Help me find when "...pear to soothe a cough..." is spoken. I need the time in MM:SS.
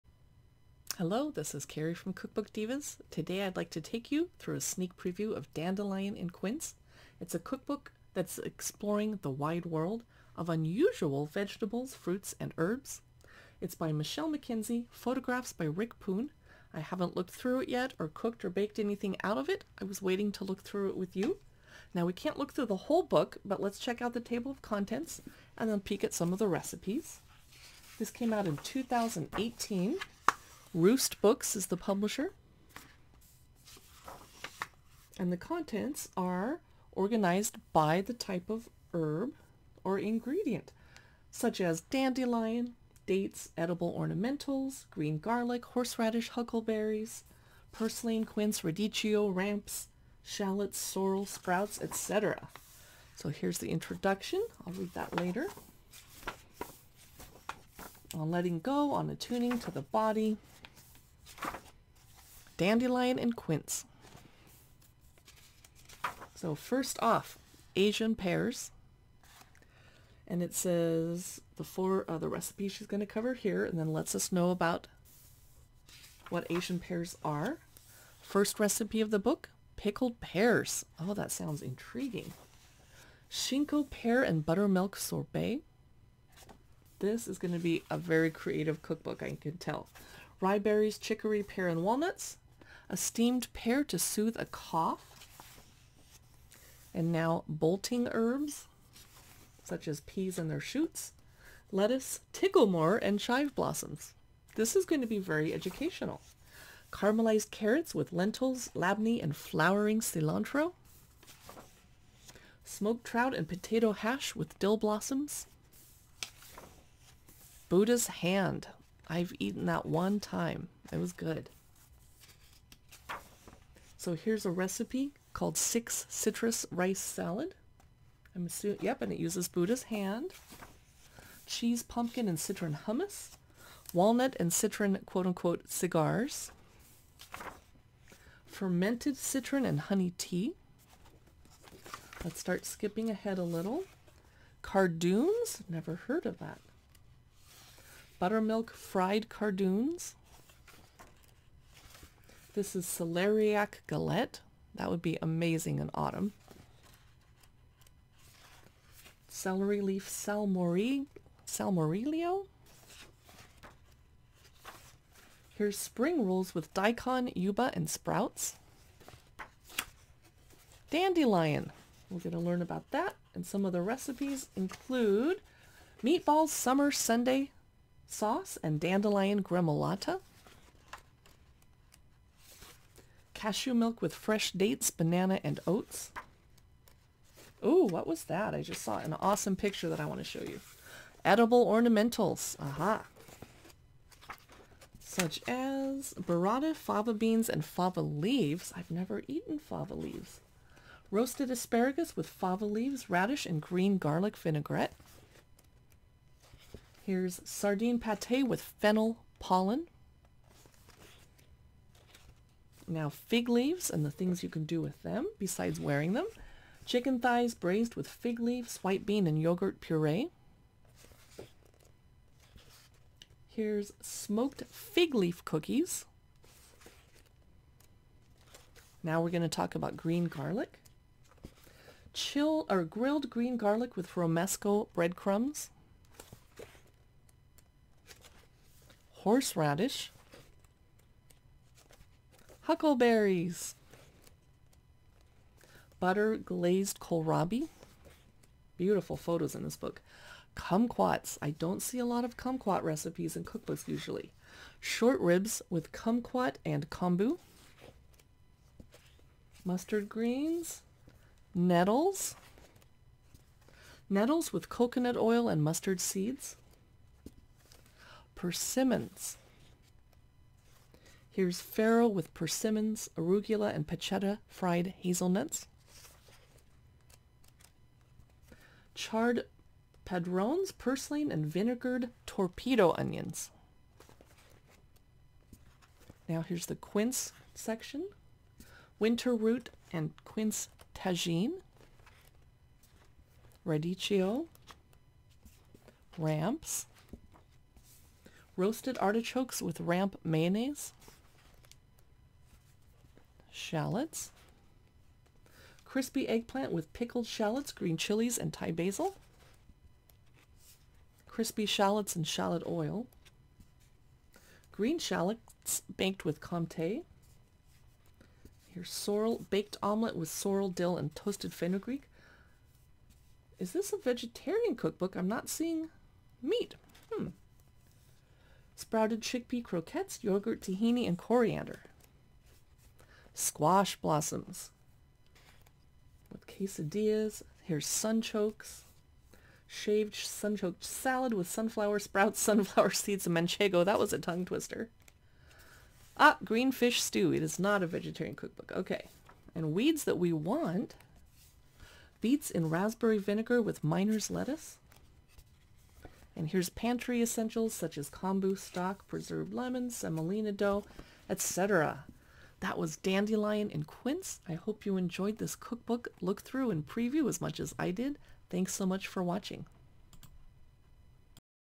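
01:33.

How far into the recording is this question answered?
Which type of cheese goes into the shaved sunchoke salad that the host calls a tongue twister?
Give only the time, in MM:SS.
05:43.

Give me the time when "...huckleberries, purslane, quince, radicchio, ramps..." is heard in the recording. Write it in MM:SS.
00:46.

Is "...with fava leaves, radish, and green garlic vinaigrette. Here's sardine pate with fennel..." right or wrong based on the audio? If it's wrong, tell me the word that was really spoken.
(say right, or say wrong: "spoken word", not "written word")
right.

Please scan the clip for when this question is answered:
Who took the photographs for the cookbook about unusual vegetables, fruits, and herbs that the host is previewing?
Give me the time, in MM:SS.
00:15.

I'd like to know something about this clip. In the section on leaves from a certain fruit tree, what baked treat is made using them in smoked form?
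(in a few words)
Smoked fig leaf cookies.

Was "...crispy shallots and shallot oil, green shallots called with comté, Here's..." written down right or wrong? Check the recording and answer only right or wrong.
wrong.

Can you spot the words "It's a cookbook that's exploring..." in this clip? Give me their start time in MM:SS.
00:07.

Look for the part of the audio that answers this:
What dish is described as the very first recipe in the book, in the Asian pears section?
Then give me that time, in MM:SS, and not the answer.
01:19.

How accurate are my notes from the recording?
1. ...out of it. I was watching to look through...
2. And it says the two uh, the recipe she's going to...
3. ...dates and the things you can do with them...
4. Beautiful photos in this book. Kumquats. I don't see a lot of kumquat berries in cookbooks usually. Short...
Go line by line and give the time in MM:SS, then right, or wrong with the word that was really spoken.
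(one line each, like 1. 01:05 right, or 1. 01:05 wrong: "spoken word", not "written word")
1. 00:19 wrong: "waiting", not "watching"
2. 01:10 wrong: "four", not "two"
3. 03:33 wrong: "leaves", not "dates"
4. 04:08 wrong: "recipes", not "berries".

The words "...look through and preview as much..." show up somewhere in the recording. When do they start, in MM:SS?
06:06.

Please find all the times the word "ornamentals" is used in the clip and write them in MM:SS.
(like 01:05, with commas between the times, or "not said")
00:43, 03:11.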